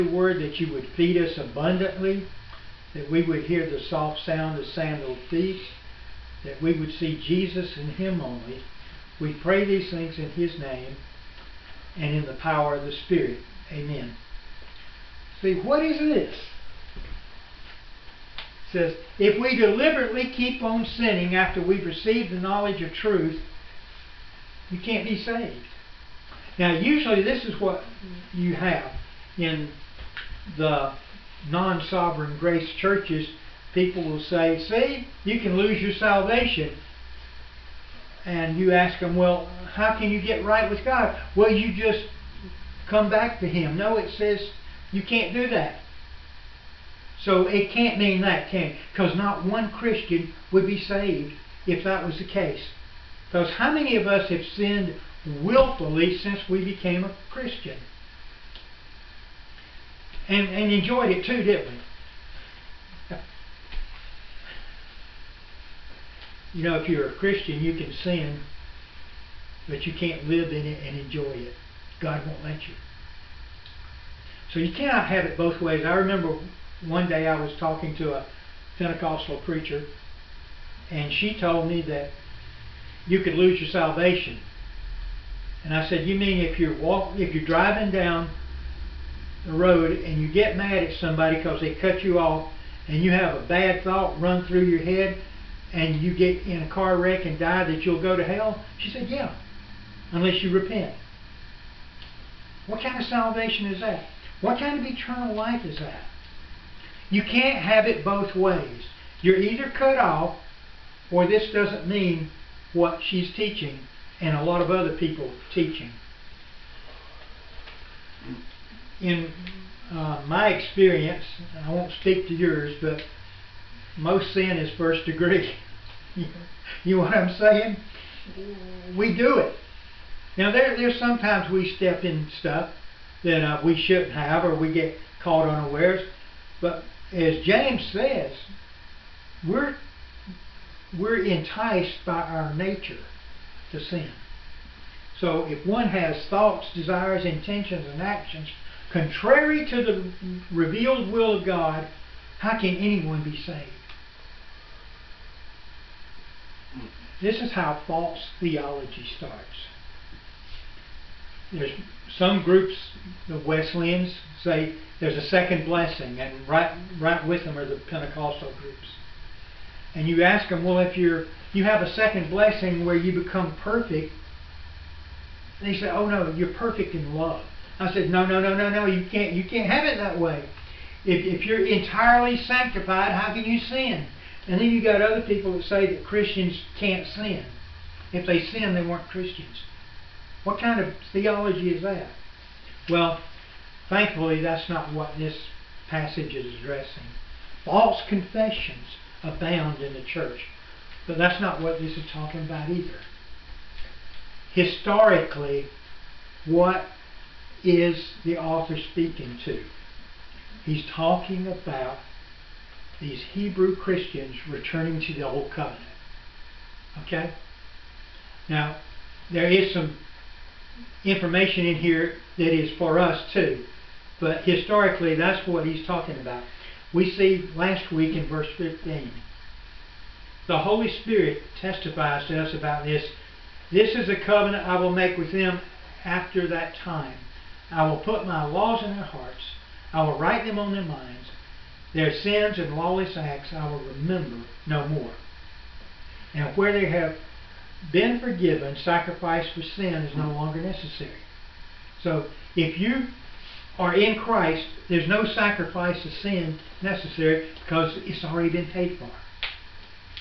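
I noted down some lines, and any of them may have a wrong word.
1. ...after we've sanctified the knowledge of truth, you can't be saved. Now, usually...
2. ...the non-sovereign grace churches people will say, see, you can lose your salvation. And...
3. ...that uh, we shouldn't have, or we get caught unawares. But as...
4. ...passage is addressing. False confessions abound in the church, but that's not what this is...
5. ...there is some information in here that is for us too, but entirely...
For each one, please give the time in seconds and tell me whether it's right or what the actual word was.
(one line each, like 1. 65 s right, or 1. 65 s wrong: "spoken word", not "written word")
1. 21 s wrong: "received", not "sanctified"
2. 30 s right
3. 133 s right
4. 195 s right
5. 219 s wrong: "historically", not "entirely".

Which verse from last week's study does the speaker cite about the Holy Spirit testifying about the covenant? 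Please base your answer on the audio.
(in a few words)
Verse 15.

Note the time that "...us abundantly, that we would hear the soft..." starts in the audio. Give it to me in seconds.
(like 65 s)
1 s.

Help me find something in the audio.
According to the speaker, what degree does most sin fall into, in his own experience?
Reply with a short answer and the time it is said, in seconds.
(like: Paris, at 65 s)
First degree, at 124 s.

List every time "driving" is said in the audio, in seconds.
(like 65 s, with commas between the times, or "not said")
87 s.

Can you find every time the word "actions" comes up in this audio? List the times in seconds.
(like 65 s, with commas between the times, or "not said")
148 s.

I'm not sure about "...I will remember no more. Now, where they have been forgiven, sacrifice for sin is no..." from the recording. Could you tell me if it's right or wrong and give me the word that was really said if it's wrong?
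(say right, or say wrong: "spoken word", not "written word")
right.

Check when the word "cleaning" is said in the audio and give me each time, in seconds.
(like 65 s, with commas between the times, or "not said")
not said.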